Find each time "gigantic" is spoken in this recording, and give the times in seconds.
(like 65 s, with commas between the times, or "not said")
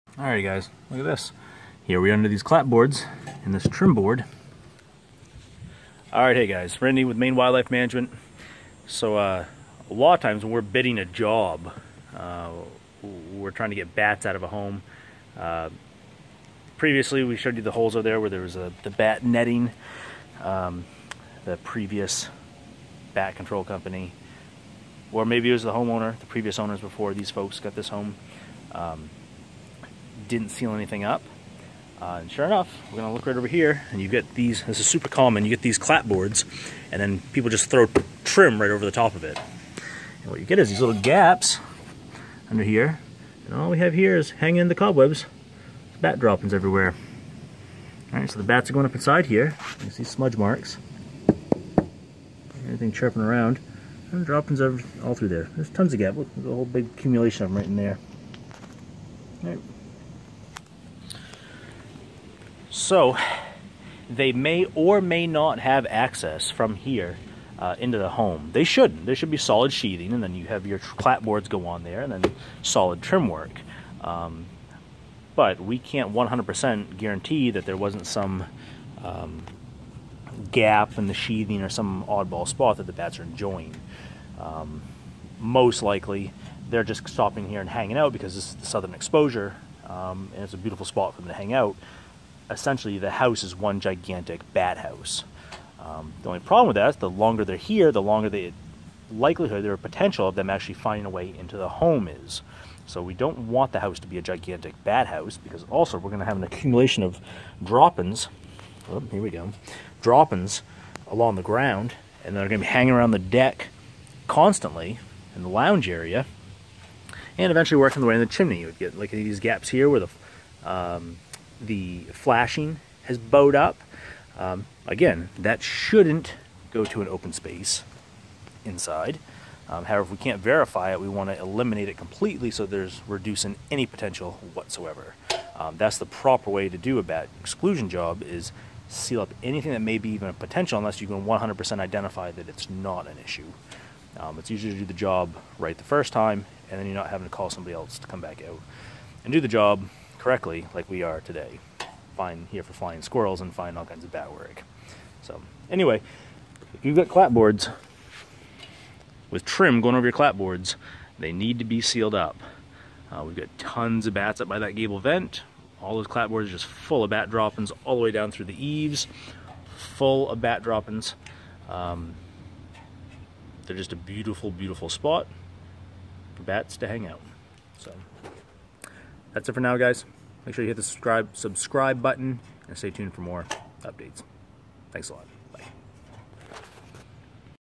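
93 s, 104 s.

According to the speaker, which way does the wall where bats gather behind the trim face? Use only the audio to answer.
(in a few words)
southern exposure.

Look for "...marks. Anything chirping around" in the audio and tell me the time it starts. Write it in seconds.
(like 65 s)
50 s.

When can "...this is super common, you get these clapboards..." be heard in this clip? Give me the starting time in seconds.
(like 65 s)
34 s.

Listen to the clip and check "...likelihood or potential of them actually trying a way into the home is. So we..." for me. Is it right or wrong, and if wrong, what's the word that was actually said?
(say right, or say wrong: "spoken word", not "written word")
wrong: "finding", not "trying".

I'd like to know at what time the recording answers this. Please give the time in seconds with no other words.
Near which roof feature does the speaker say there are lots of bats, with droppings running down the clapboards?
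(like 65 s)
164 s.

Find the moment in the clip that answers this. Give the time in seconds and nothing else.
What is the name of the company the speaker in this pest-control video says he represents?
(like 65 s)
7 s.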